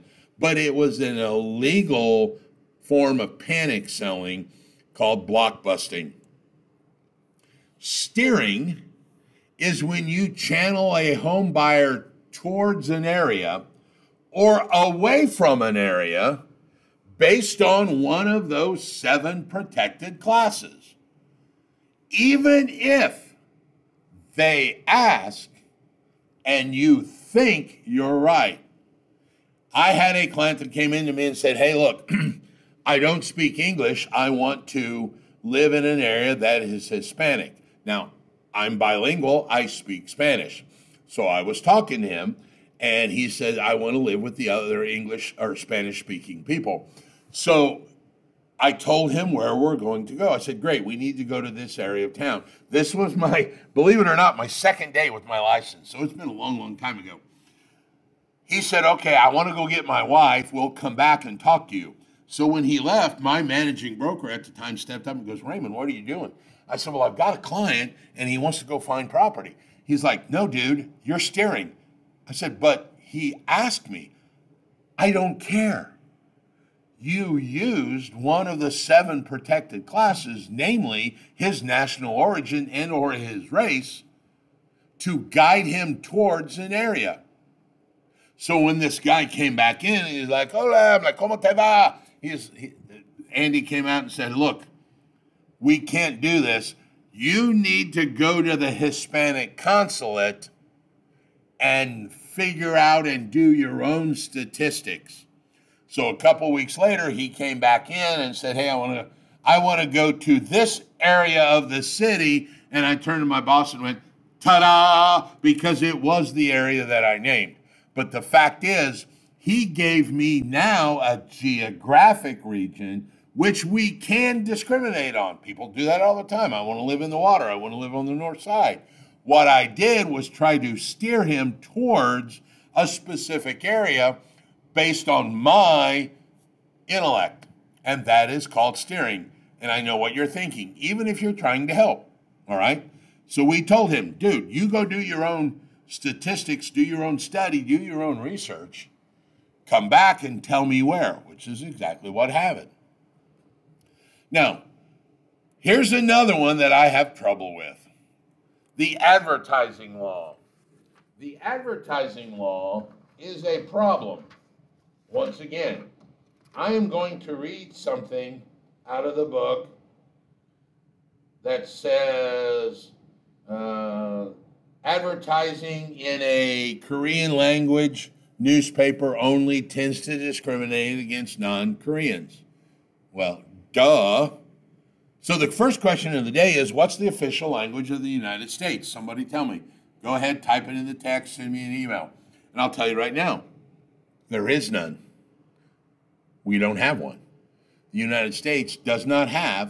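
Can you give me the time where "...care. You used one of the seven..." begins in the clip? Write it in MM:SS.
01:15.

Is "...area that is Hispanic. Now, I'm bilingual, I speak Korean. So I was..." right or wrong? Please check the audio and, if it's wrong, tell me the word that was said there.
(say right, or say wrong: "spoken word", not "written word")
wrong: "Spanish", not "Korean".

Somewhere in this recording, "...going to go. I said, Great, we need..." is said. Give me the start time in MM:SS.
00:49.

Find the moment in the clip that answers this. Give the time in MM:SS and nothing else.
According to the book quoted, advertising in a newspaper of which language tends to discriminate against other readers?
02:56.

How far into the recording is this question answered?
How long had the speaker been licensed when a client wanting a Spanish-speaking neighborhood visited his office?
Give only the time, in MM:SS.
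00:54.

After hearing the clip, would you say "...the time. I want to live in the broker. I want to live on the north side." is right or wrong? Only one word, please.
wrong.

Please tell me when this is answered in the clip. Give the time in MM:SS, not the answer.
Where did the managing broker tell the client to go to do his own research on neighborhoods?
01:38.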